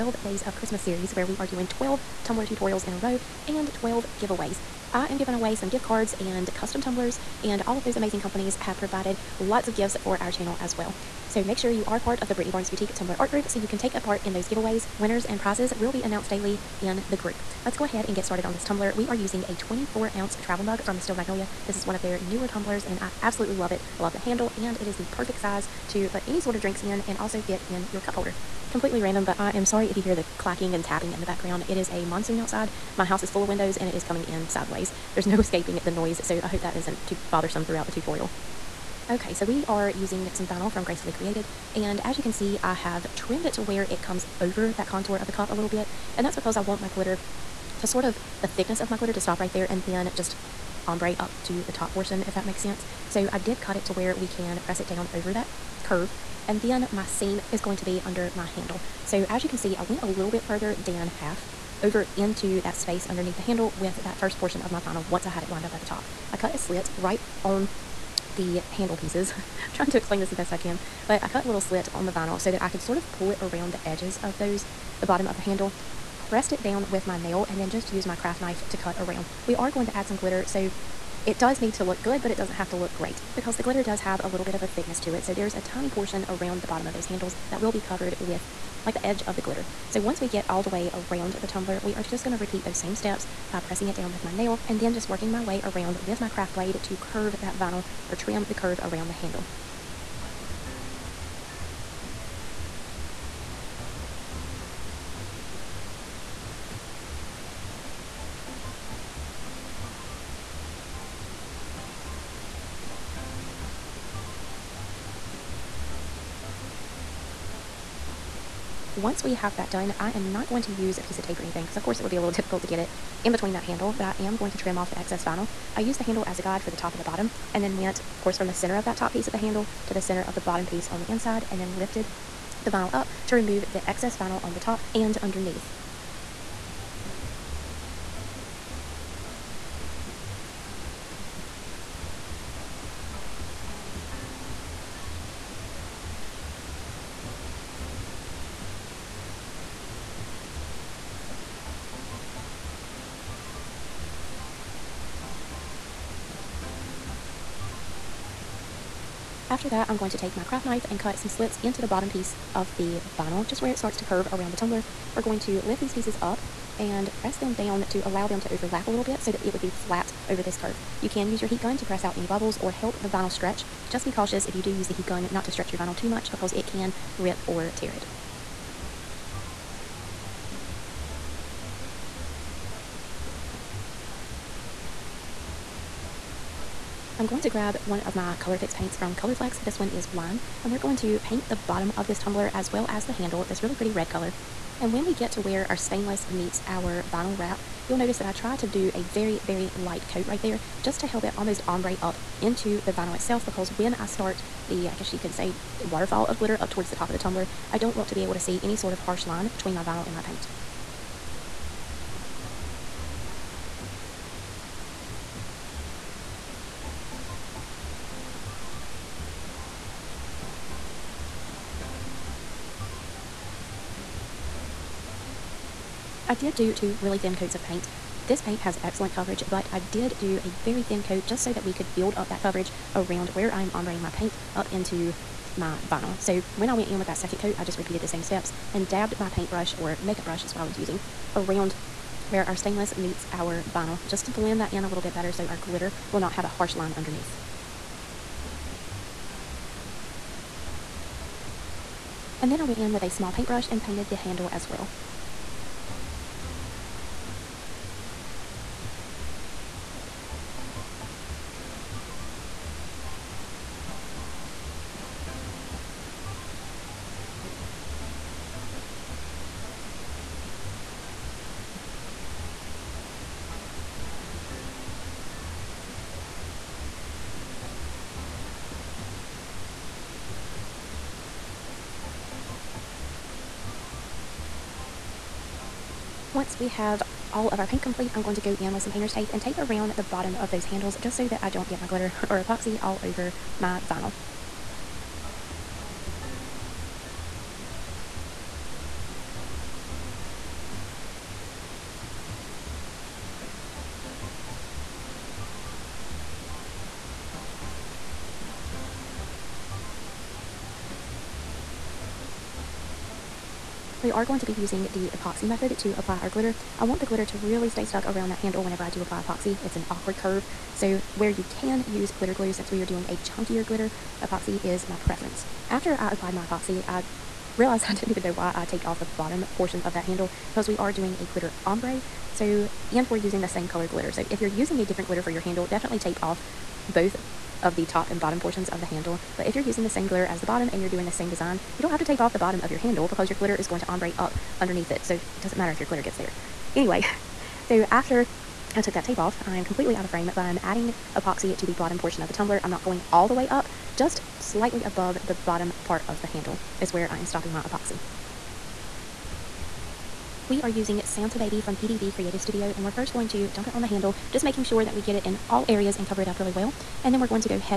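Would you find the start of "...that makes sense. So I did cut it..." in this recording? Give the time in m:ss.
0:52.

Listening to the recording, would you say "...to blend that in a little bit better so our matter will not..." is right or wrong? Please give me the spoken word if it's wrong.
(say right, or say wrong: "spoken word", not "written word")
wrong: "glitter", not "matter".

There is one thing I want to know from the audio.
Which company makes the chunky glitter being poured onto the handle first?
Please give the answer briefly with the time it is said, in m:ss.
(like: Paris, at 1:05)
PDB Creative Studio, at 6:01.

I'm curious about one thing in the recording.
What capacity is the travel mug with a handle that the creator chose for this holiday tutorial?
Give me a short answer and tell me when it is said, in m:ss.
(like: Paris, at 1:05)
24 ounce, at 0:19.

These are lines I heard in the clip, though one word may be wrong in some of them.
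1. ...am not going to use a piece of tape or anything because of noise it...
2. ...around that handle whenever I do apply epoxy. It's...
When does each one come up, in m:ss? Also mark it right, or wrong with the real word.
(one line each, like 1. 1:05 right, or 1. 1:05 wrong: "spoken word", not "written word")
1. 2:00 wrong: "course", not "noise"
2. 5:18 right.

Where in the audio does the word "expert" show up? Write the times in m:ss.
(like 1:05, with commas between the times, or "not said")
not said.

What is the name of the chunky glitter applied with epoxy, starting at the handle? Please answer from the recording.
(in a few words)
Santa Baby.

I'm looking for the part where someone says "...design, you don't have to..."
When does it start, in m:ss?
5:41.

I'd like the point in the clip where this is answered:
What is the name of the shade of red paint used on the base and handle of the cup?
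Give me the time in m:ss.
3:10.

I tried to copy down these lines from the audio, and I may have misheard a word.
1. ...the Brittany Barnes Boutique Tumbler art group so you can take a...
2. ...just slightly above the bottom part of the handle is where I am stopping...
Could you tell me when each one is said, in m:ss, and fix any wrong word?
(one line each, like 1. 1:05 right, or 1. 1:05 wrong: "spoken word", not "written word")
1. 0:12 right
2. 5:53 right.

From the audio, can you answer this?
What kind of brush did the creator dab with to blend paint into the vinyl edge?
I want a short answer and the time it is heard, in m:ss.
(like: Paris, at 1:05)
makeup brush, at 3:59.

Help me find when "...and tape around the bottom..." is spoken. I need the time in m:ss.
4:49.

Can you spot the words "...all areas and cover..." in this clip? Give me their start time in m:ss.
6:05.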